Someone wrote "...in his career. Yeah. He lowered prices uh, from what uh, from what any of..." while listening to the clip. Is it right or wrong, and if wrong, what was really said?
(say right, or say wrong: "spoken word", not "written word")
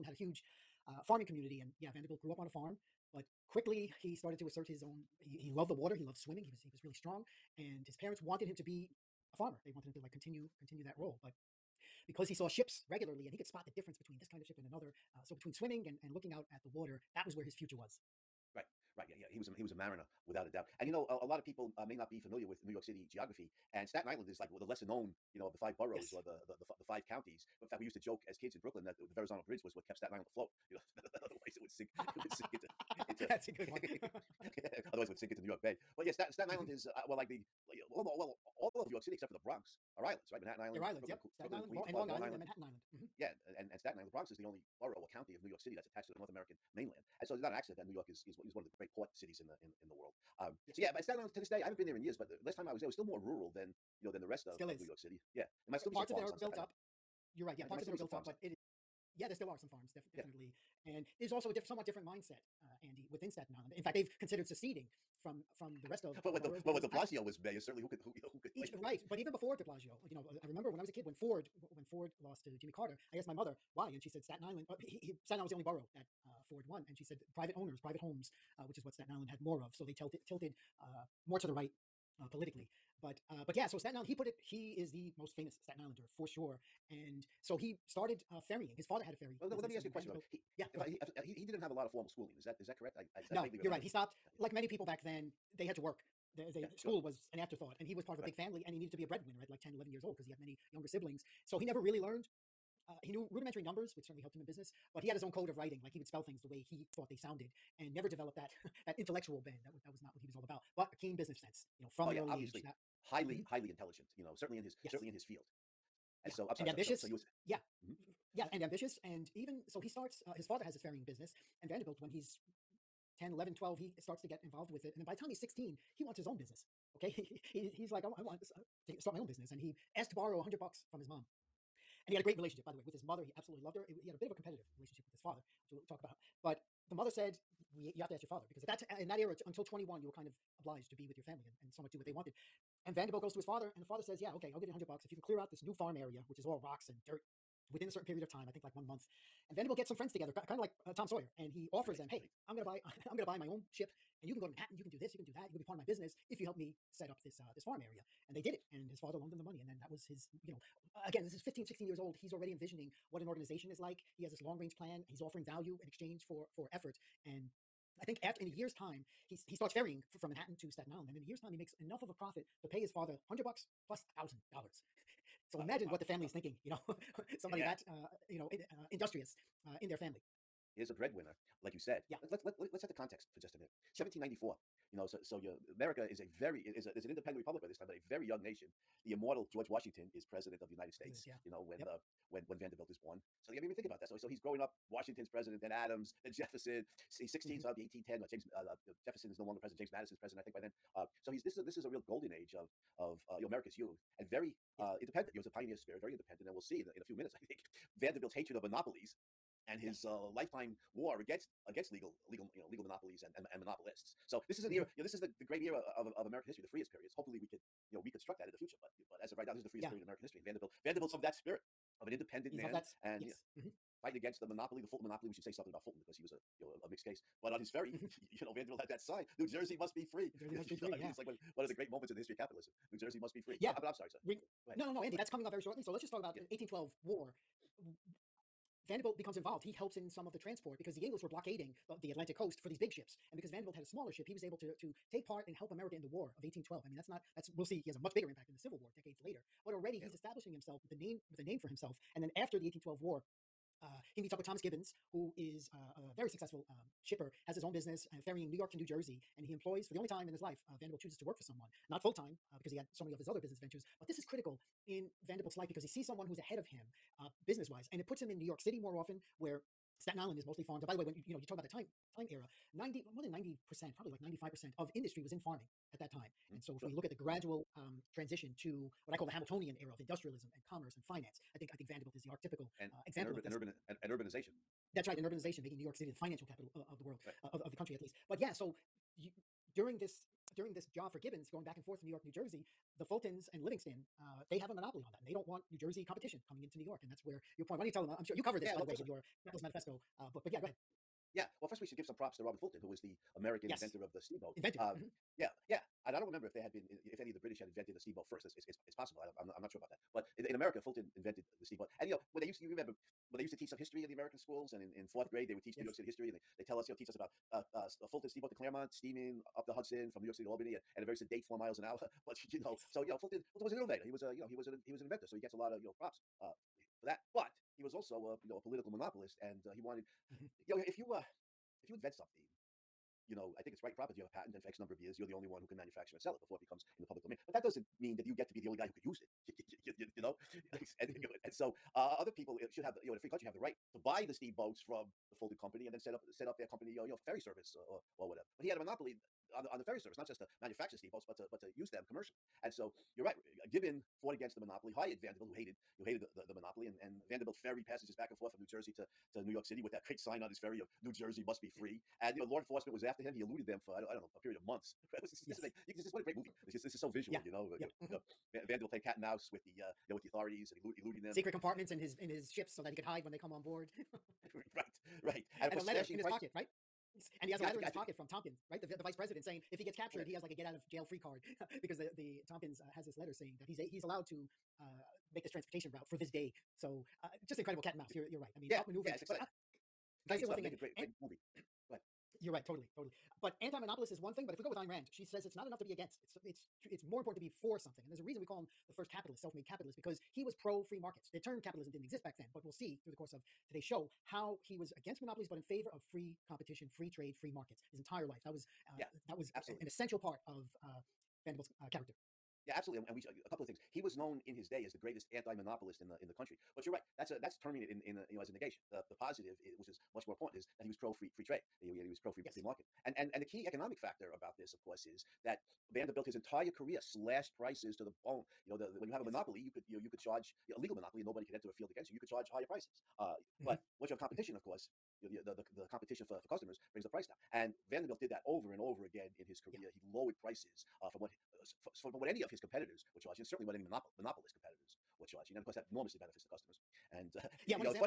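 right.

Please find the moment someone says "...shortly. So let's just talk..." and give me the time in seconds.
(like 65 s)
235 s.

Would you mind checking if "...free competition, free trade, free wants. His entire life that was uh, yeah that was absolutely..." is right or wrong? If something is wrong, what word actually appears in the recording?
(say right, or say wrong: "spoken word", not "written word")
wrong: "markets", not "wants".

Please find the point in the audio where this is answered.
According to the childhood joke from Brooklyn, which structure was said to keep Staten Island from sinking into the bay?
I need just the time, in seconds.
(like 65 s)
29 s.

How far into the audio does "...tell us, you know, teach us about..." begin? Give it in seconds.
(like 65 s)
316 s.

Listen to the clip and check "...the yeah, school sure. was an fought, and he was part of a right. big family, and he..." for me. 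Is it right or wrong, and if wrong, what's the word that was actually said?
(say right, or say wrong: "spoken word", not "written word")
wrong: "afterthought", not "fought".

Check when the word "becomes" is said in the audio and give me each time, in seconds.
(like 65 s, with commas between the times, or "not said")
239 s, 336 s.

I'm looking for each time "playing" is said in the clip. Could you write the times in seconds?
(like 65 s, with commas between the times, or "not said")
368 s.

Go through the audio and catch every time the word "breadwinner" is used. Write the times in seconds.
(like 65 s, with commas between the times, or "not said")
99 s, 180 s.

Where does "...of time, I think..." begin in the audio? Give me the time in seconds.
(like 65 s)
148 s.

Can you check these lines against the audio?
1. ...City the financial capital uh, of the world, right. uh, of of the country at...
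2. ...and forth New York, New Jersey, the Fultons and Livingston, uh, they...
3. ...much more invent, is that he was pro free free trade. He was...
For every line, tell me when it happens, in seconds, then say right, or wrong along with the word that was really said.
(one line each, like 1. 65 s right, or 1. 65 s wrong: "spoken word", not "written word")
1. 285 s right
2. 291 s right
3. 420 s wrong: "important", not "invent".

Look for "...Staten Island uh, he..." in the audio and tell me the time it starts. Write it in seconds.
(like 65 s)
74 s.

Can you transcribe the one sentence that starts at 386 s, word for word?
So uh, just incredible cat and mouse.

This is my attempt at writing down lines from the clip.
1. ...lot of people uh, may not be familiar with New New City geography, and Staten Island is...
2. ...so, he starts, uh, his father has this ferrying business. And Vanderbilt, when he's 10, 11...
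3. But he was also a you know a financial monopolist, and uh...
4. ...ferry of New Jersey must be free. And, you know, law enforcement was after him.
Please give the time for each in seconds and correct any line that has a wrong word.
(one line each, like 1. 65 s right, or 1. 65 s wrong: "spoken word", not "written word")
1. 21 s wrong: "York", not "New"
2. 119 s right
3. 327 s wrong: "political", not "financial"
4. 360 s right.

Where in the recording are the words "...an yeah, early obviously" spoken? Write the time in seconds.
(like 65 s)
112 s.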